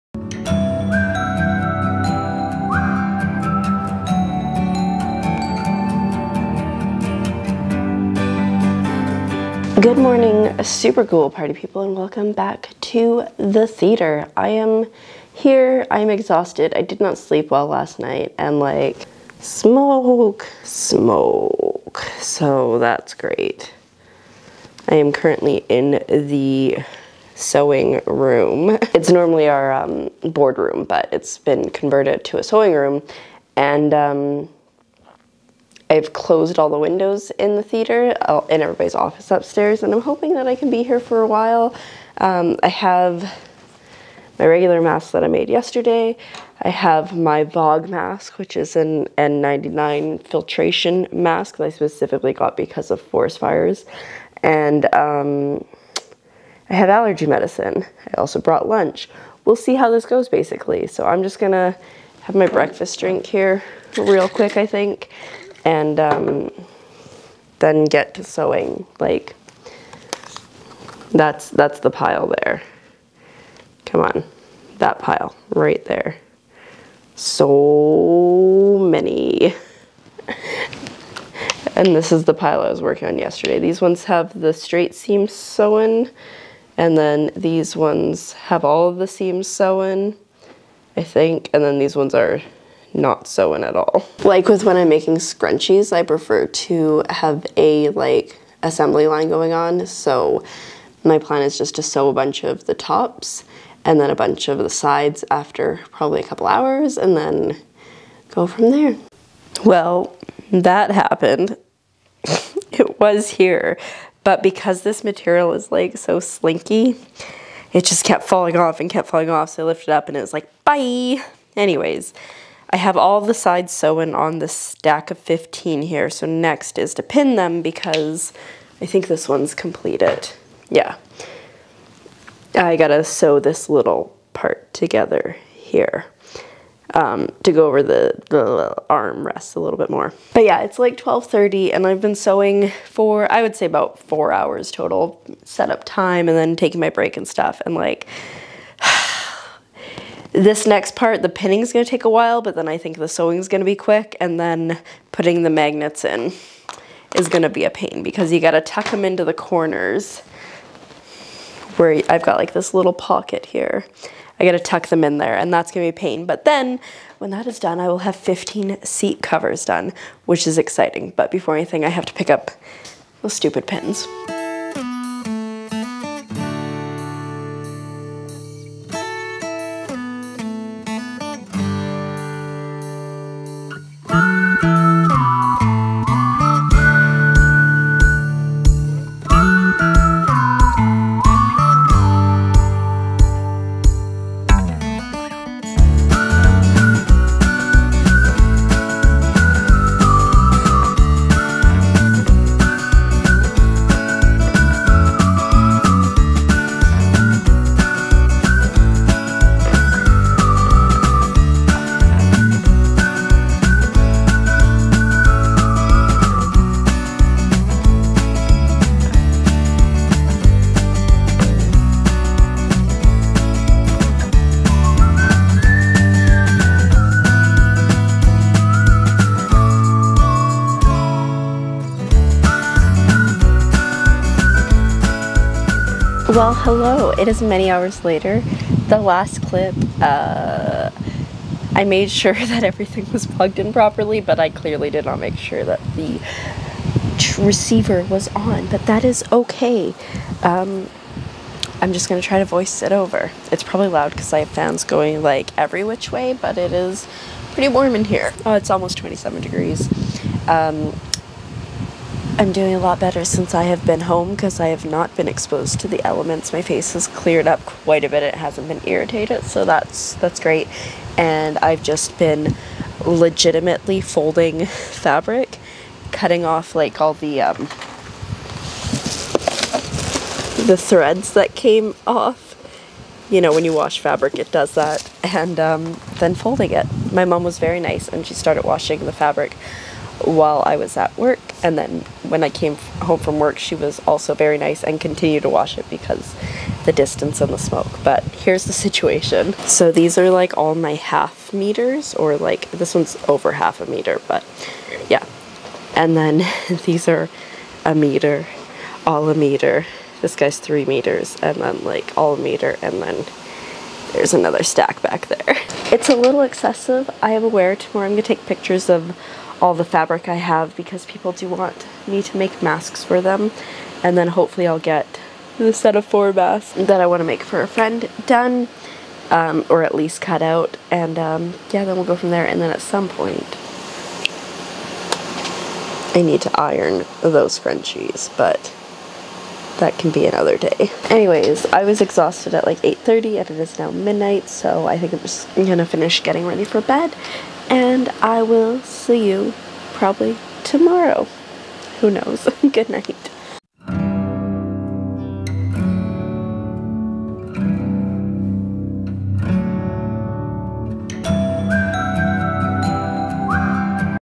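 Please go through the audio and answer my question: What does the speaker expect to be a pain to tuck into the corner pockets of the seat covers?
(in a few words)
magnets.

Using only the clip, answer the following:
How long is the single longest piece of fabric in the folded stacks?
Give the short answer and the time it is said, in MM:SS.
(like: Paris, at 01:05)
3 meters, at 05:10.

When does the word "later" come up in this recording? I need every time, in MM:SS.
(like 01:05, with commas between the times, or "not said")
03:58.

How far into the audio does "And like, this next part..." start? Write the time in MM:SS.
02:27.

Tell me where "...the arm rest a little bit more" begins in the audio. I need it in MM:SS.
02:18.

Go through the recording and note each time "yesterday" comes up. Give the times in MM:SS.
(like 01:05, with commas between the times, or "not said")
00:45, 01:23.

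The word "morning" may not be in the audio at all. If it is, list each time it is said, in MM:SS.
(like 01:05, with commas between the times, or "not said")
00:09.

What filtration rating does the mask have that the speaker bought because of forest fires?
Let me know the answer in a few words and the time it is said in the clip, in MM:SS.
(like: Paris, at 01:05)
N99, at 00:49.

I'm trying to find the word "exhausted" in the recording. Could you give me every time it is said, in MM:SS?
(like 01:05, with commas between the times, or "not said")
00:16, 05:42.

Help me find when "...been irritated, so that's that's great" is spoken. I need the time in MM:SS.
04:28.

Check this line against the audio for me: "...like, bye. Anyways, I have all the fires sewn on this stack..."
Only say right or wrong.
wrong.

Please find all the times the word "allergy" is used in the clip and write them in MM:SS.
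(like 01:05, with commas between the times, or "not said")
00:56.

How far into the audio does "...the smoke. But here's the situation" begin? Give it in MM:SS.
04:57.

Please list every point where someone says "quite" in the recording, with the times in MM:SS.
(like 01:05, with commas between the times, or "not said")
04:27.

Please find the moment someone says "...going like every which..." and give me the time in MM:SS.
04:14.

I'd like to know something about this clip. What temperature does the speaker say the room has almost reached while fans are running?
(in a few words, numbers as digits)
27 degrees.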